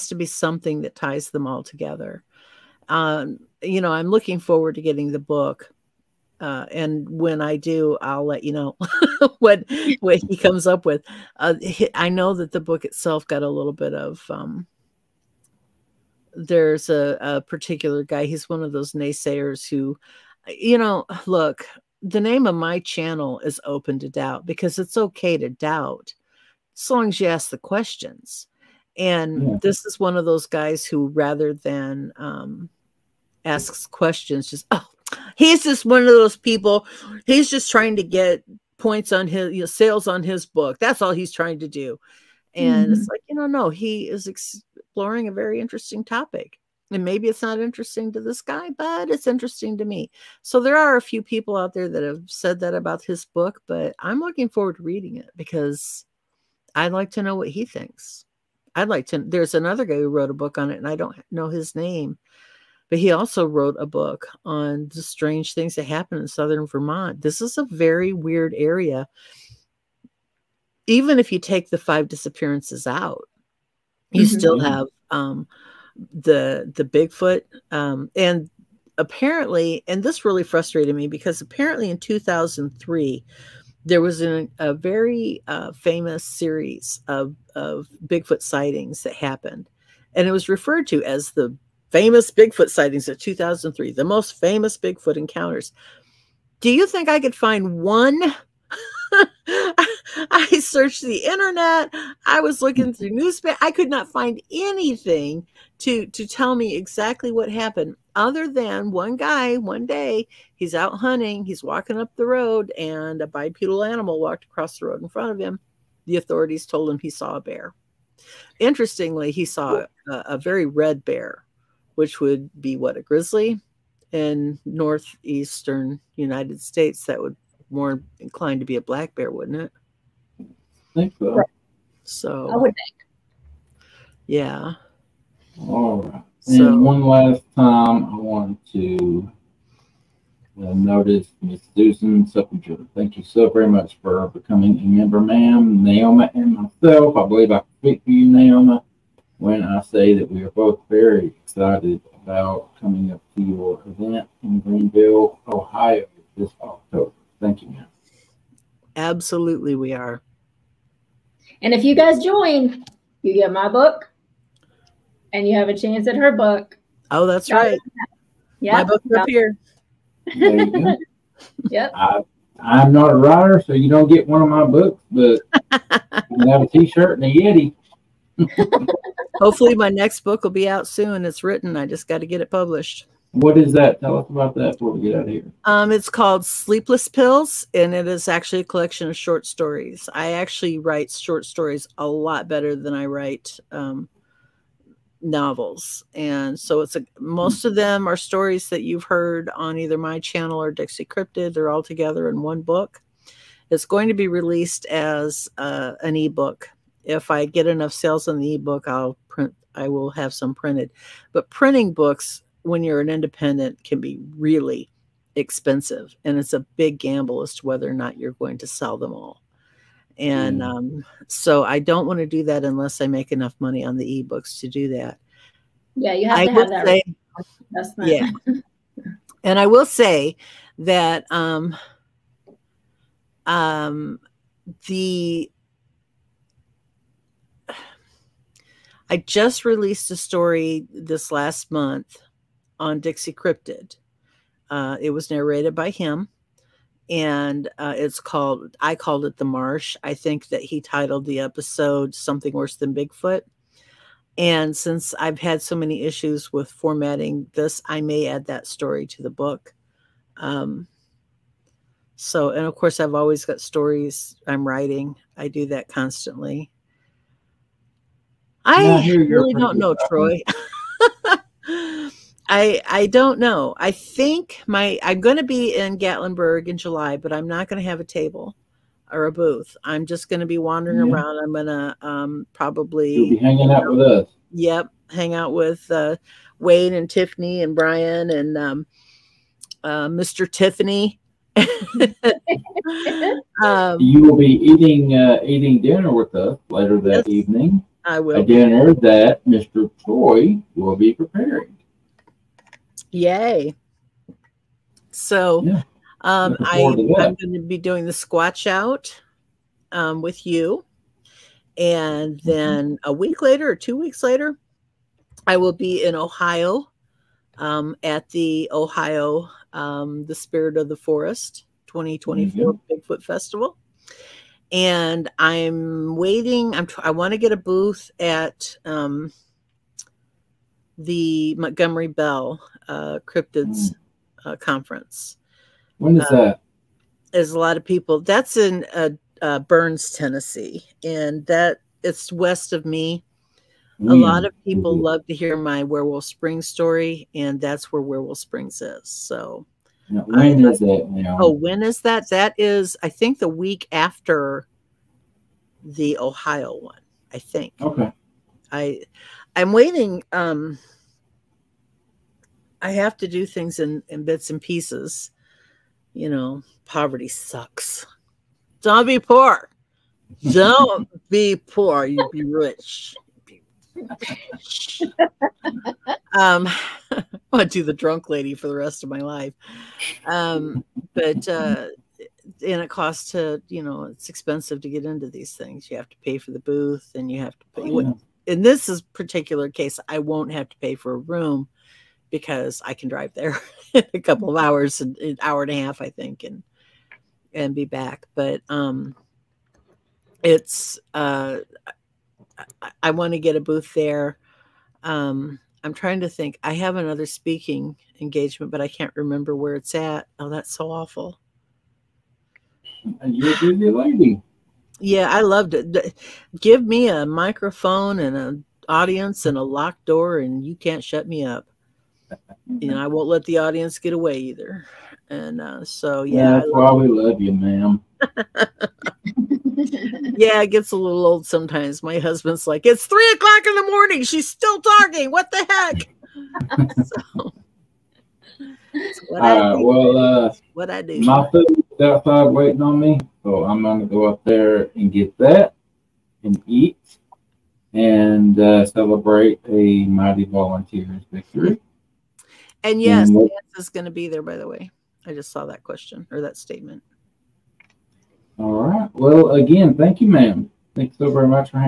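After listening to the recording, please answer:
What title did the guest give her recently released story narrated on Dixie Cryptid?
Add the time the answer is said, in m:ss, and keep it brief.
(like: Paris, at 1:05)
The Marsh, at 4:09.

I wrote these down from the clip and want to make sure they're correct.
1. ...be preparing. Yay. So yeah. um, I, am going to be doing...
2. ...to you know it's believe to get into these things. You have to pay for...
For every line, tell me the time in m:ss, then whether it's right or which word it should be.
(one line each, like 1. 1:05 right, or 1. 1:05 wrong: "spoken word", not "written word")
1. 5:00 right
2. 6:23 wrong: "expensive", not "believe".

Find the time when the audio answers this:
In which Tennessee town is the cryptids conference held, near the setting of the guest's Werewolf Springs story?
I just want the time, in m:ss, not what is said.
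5:39.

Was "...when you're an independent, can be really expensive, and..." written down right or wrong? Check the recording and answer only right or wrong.
right.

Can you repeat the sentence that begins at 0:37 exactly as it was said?
He's just trying to get points on his you know, sales on his book.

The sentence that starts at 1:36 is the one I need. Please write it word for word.
Do you think I could find one?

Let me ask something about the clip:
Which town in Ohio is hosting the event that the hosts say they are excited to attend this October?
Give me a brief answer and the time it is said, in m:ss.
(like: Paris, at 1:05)
Greenville, at 2:34.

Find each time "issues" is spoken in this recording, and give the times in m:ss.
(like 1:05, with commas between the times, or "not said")
4:16.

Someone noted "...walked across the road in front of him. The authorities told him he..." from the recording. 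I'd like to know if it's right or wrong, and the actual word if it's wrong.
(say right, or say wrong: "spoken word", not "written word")
right.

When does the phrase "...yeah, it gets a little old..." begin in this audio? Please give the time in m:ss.
7:09.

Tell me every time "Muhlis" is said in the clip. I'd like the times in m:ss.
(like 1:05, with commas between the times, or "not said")
not said.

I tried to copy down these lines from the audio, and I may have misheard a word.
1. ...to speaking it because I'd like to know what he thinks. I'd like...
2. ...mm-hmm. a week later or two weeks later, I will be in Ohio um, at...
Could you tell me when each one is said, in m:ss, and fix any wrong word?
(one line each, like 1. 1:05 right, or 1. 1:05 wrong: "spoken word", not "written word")
1. 0:54 wrong: "reading", not "speaking"
2. 5:12 right.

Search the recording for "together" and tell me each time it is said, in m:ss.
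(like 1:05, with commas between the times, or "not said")
0:01, 3:21.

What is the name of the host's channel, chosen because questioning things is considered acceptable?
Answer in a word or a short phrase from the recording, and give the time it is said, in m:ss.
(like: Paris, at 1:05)
Open to Doubt, at 0:23.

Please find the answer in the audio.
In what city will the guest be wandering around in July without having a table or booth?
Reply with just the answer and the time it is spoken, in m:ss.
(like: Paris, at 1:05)
Gatlinburg, at 4:35.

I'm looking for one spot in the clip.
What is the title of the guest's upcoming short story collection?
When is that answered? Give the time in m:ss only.
3:06.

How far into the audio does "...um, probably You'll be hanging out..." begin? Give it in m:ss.
4:42.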